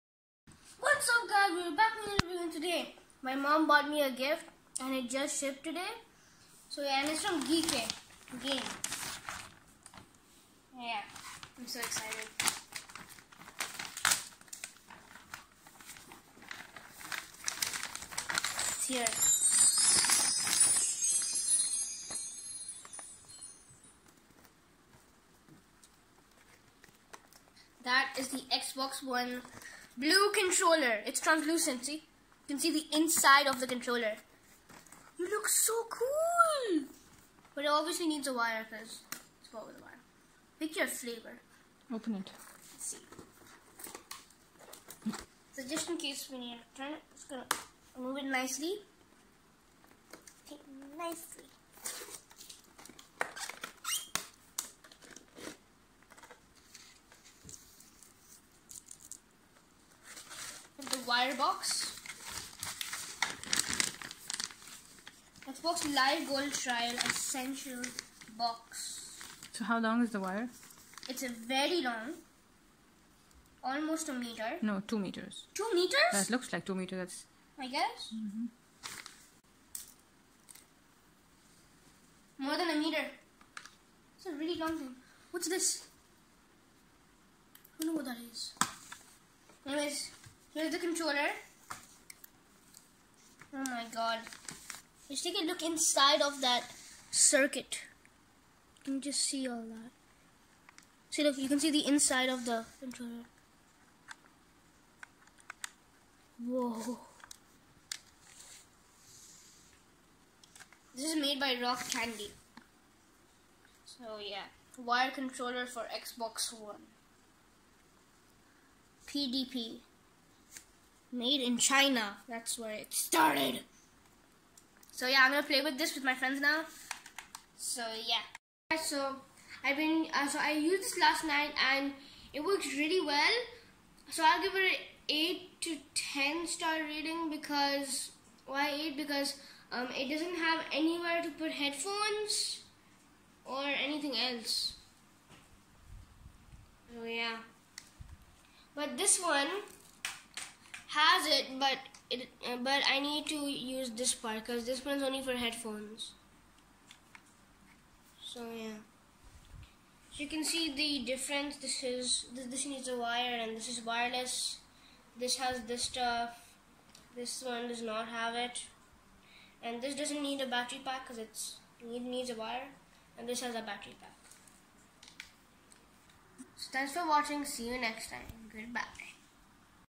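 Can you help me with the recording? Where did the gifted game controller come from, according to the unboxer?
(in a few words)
Geek Game.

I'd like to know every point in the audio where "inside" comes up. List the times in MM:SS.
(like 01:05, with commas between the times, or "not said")
00:32, 01:35, 01:41.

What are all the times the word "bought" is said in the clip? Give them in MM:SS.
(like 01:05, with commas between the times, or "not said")
00:03, 00:39.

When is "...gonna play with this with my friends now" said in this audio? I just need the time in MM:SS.
02:05.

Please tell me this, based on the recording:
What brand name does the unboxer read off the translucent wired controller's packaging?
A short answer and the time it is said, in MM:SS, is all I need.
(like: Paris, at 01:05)
Rock Candy, at 01:51.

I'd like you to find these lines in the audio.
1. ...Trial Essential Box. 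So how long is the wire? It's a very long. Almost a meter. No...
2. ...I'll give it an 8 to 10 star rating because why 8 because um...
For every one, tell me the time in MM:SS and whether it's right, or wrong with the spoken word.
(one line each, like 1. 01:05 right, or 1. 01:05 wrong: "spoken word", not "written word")
1. 01:06 right
2. 02:14 right.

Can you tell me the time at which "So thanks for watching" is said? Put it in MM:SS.
02:56.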